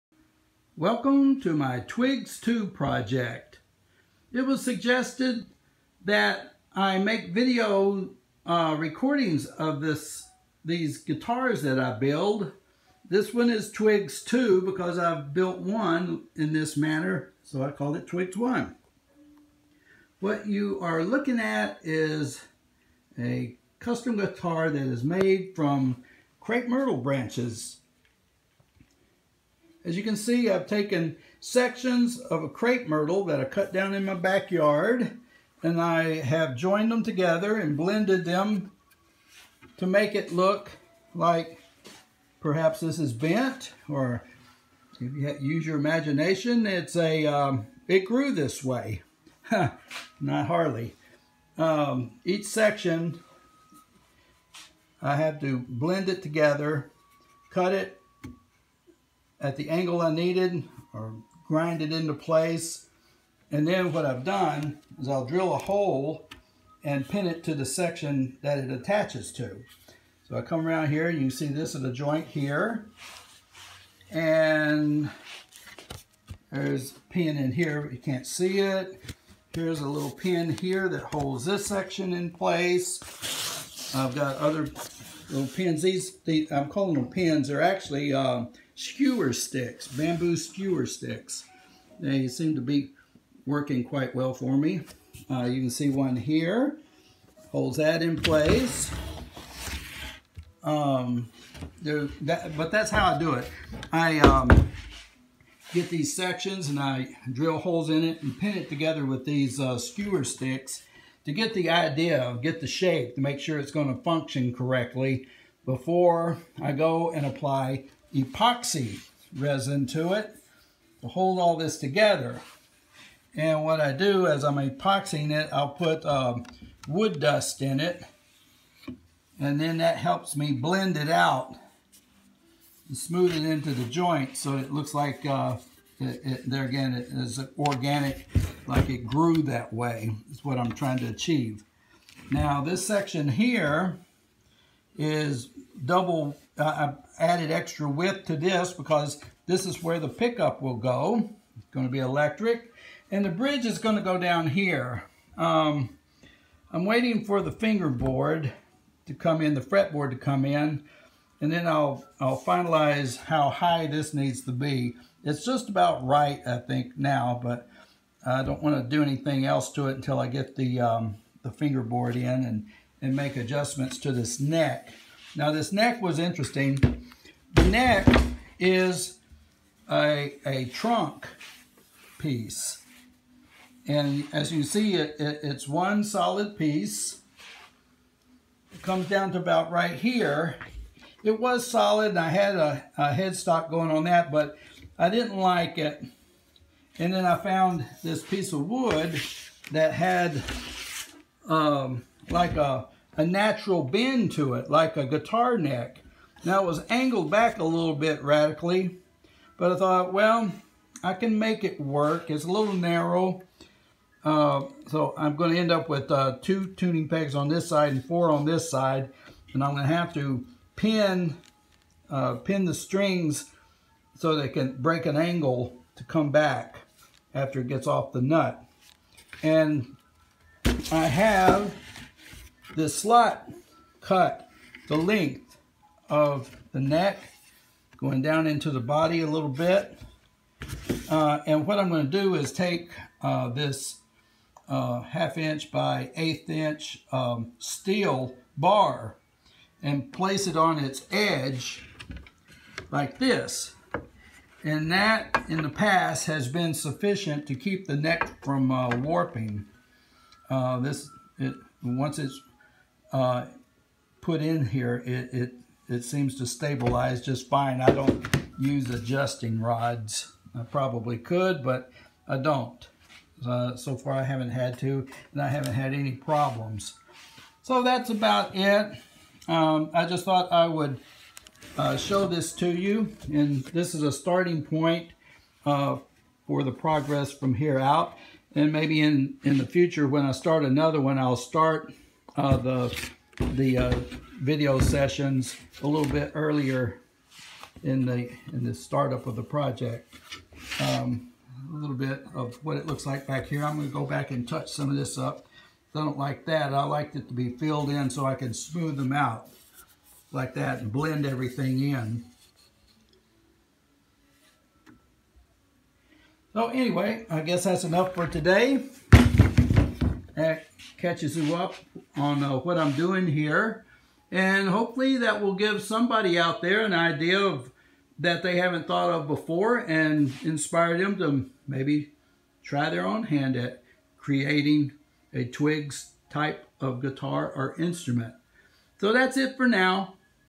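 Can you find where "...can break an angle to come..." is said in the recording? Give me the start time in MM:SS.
03:44.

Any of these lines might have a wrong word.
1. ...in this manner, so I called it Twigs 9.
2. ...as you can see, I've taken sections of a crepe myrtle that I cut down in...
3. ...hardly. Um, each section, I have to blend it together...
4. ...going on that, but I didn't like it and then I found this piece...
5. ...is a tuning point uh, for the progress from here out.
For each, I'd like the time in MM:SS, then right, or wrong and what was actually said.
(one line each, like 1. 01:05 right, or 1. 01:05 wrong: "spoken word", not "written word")
1. 00:16 wrong: "1", not "9"
2. 00:29 right
3. 00:50 right
4. 03:13 right
5. 04:43 wrong: "starting", not "tuning".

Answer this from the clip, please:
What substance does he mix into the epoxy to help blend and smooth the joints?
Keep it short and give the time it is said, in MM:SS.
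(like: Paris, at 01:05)
wood dust, at 02:06.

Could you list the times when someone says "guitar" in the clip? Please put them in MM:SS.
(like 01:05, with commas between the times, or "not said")
00:10, 00:24, 03:25, 05:37.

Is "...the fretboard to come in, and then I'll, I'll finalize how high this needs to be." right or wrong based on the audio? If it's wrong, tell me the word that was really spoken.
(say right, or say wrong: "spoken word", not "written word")
right.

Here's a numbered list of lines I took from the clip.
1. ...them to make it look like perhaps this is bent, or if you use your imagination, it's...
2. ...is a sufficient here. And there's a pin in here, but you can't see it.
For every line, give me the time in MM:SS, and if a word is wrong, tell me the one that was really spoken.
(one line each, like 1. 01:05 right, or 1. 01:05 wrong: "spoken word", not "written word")
1. 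00:38 right
2. 01:11 wrong: "joint", not "sufficient".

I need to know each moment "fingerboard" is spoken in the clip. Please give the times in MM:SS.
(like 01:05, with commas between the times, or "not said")
02:37, 02:51.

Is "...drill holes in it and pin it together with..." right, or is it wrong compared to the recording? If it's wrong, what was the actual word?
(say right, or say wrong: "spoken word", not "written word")
right.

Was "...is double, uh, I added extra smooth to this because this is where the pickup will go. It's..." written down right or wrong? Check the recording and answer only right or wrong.
wrong.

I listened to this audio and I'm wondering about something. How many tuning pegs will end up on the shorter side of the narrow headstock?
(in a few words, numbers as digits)
2.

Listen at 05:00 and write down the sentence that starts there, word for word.
Um, a little bit of what it looks like back here.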